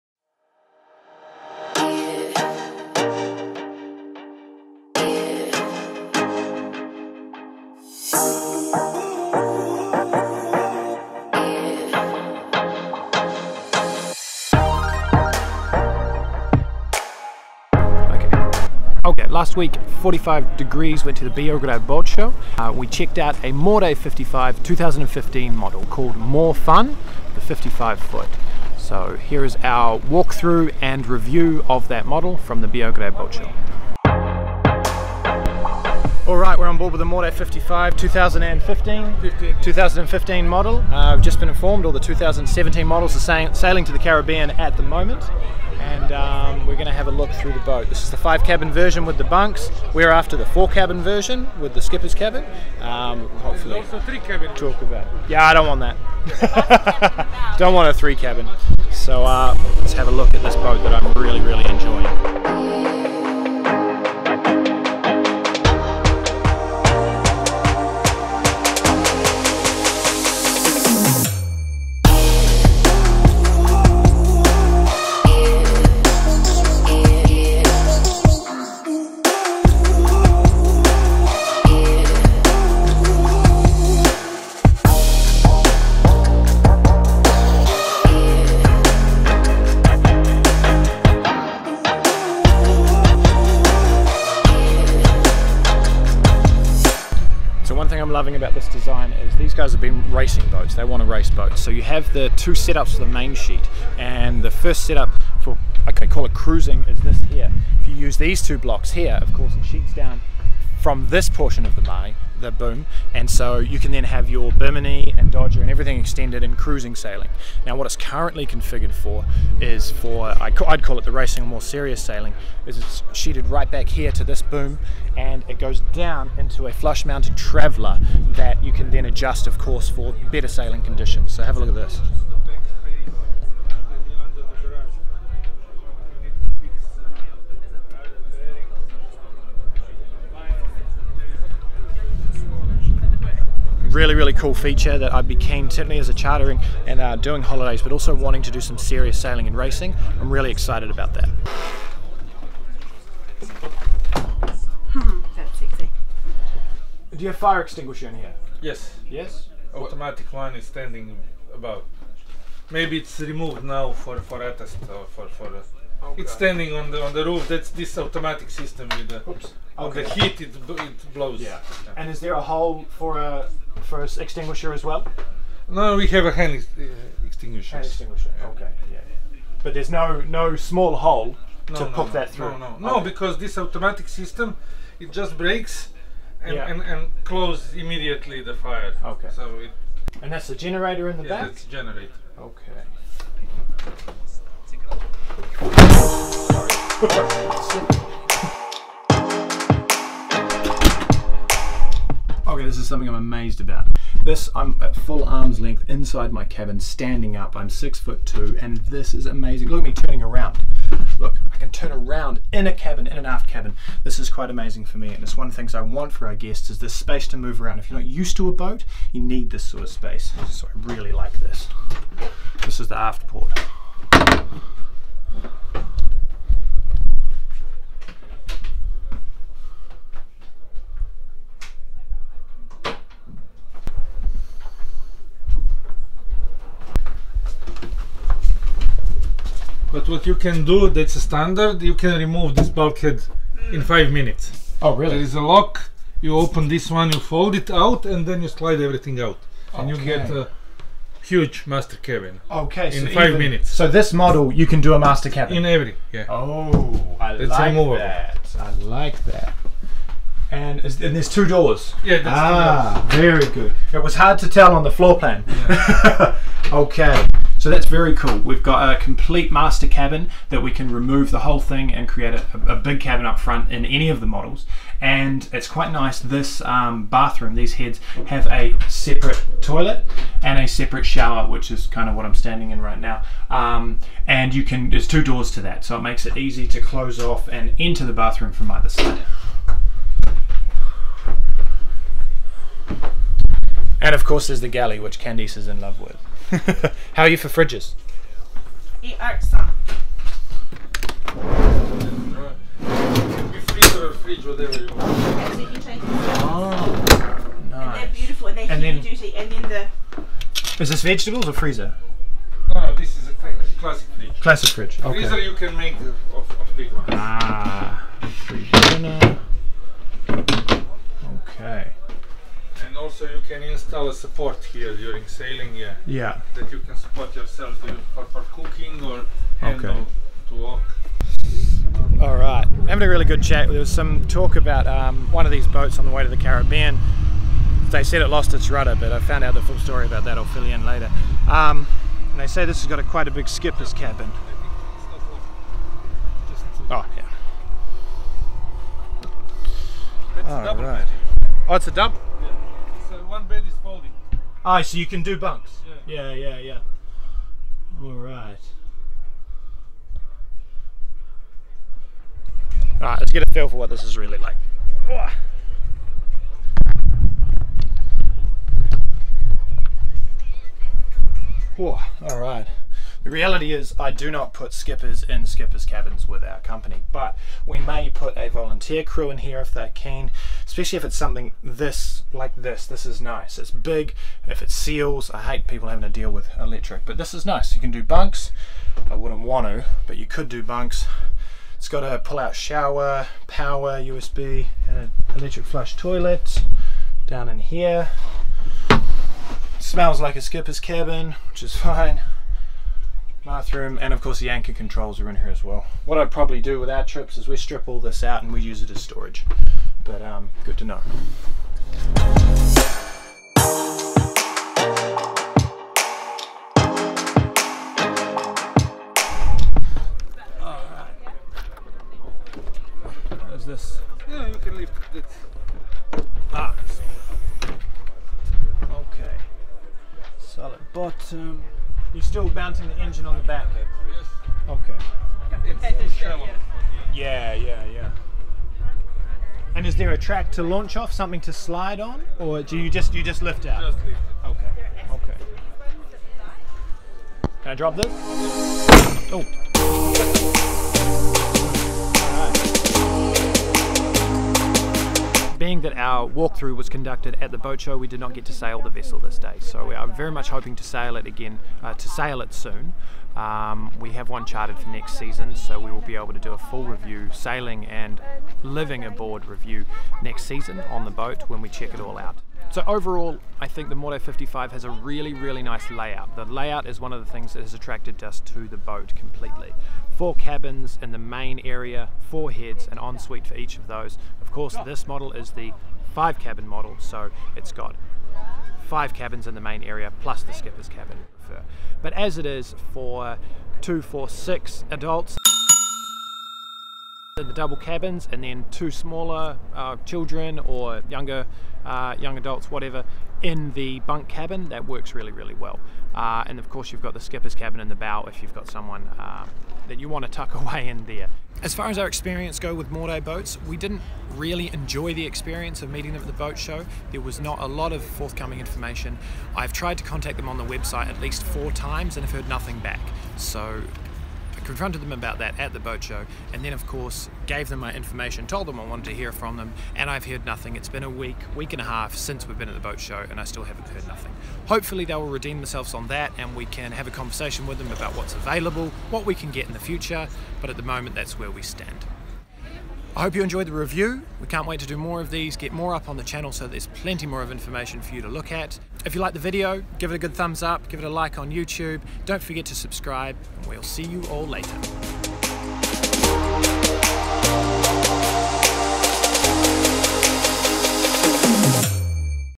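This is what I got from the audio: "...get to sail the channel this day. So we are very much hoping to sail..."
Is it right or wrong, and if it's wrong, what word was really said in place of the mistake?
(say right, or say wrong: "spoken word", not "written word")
wrong: "vessel", not "channel".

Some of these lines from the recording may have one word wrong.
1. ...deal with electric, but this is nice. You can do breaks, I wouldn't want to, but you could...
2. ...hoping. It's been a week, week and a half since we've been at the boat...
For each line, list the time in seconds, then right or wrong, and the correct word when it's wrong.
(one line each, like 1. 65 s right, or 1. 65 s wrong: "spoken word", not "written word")
1. 386 s wrong: "bunks", not "breaks"
2. 530 s wrong: "nothing", not "hoping".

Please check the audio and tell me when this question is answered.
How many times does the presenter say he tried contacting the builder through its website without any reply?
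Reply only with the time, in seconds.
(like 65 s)
521 s.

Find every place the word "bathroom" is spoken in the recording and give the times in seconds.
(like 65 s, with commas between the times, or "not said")
277 s, 288 s, 403 s.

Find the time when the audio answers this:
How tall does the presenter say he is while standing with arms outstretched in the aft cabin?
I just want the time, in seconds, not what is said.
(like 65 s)
207 s.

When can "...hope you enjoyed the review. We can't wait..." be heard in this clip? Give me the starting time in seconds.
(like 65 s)
543 s.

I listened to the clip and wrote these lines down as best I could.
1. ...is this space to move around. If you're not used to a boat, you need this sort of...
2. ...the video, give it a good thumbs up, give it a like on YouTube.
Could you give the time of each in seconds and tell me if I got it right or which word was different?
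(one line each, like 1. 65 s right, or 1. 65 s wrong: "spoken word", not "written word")
1. 216 s right
2. 549 s right.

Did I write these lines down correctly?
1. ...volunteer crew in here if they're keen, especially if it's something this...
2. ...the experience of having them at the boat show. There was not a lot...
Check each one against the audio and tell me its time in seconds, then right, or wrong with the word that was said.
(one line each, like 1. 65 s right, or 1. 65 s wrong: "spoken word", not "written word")
1. 378 s right
2. 515 s wrong: "meeting", not "having".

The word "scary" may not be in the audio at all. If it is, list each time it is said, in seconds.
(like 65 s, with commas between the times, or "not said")
not said.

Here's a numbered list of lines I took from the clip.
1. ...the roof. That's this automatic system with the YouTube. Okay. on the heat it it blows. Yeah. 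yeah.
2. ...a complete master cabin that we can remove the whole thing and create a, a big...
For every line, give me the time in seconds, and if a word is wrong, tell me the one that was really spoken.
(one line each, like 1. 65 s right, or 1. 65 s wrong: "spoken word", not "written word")
1. 167 s wrong: "Oops", not "YouTube"
2. 268 s right.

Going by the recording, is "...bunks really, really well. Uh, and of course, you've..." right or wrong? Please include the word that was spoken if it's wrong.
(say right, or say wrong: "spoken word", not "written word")
wrong: "works", not "bunks".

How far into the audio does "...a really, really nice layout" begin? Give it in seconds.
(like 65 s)
474 s.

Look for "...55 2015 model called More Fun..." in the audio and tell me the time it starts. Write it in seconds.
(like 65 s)
23 s.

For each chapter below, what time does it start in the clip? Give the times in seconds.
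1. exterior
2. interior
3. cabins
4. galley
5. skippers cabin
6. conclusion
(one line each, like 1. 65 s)
1. 36 s
2. 155 s
3. 206 s
4. 294 s
5. 343 s
6. 456 s.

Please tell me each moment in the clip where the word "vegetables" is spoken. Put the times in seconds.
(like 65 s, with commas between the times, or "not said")
311 s.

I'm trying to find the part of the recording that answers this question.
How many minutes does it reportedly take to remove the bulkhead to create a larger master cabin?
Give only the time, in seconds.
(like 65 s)
243 s.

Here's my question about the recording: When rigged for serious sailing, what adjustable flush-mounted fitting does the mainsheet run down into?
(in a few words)
traveller.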